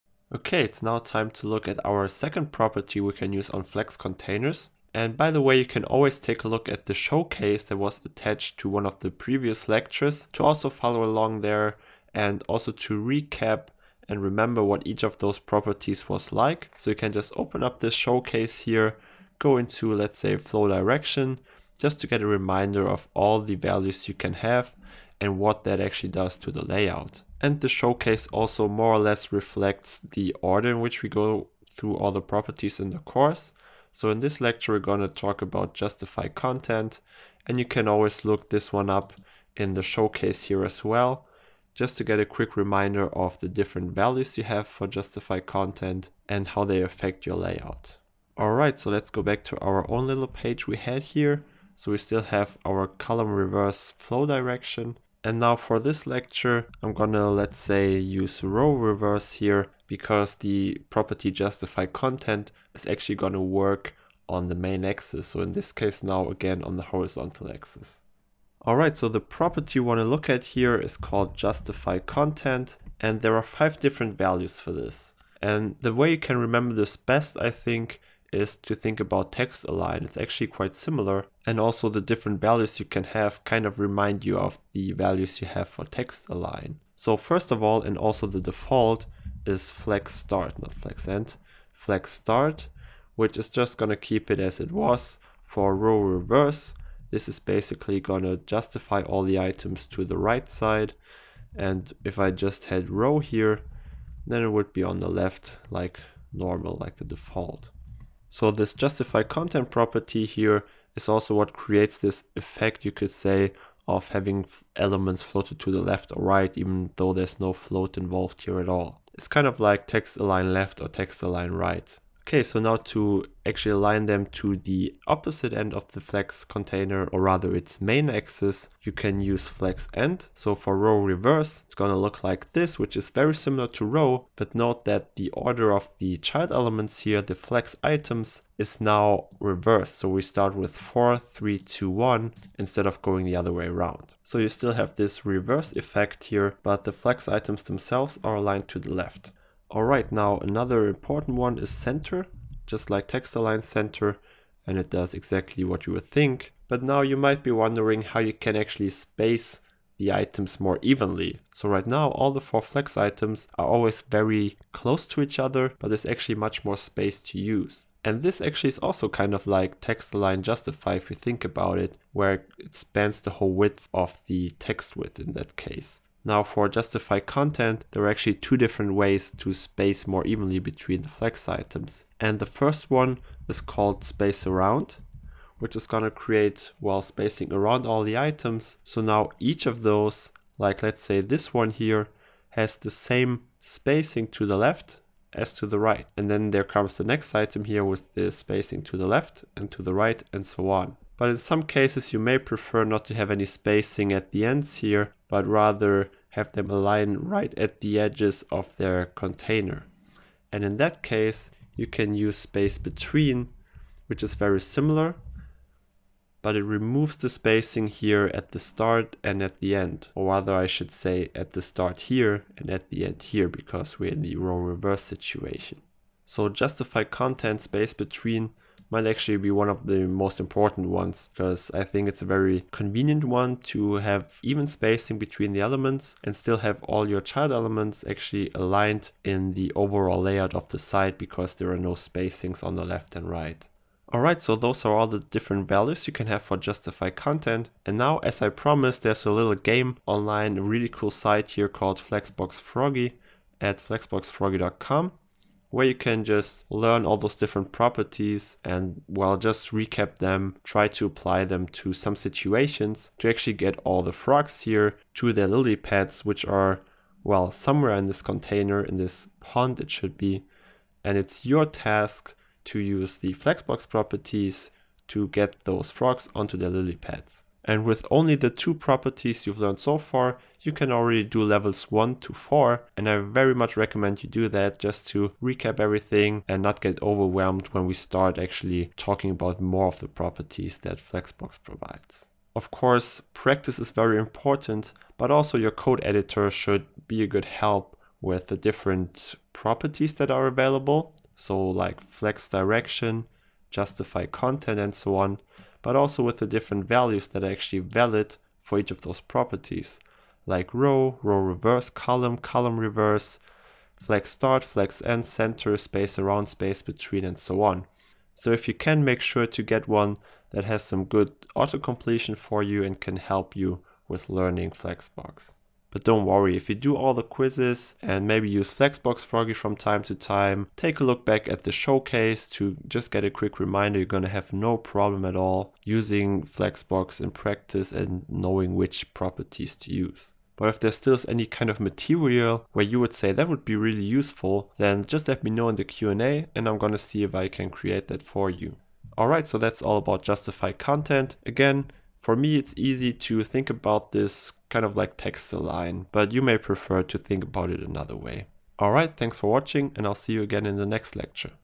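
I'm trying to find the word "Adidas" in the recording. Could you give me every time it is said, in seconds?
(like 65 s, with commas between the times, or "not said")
not said.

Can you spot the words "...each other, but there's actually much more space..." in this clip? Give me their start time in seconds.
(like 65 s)
165 s.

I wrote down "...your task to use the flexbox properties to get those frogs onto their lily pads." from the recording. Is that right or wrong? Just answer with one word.
right.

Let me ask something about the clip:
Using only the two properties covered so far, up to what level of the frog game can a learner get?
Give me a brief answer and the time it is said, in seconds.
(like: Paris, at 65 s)
4, at 281 s.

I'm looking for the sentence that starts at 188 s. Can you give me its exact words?
So now each of those, like let's say this one here, has the same spacing to the left as to the right.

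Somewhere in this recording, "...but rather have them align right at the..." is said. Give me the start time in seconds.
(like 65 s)
205 s.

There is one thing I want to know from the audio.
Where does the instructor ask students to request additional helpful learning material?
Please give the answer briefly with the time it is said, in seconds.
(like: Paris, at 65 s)
Q&A, at 345 s.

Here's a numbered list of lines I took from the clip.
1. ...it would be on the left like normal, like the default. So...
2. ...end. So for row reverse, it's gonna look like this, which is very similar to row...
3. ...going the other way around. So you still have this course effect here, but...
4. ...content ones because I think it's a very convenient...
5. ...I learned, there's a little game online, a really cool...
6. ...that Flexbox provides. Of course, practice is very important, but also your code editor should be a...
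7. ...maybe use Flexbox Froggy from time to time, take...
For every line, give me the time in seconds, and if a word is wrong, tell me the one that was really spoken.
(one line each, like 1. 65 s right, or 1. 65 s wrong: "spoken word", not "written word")
1. 104 s right
2. 129 s right
3. 143 s wrong: "reverse", not "course"
4. 230 s wrong: "important", not "content"
5. 248 s wrong: "promised", not "learned"
6. 290 s right
7. 328 s right.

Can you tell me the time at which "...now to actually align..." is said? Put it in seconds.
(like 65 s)
122 s.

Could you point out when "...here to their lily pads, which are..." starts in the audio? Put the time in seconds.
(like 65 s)
264 s.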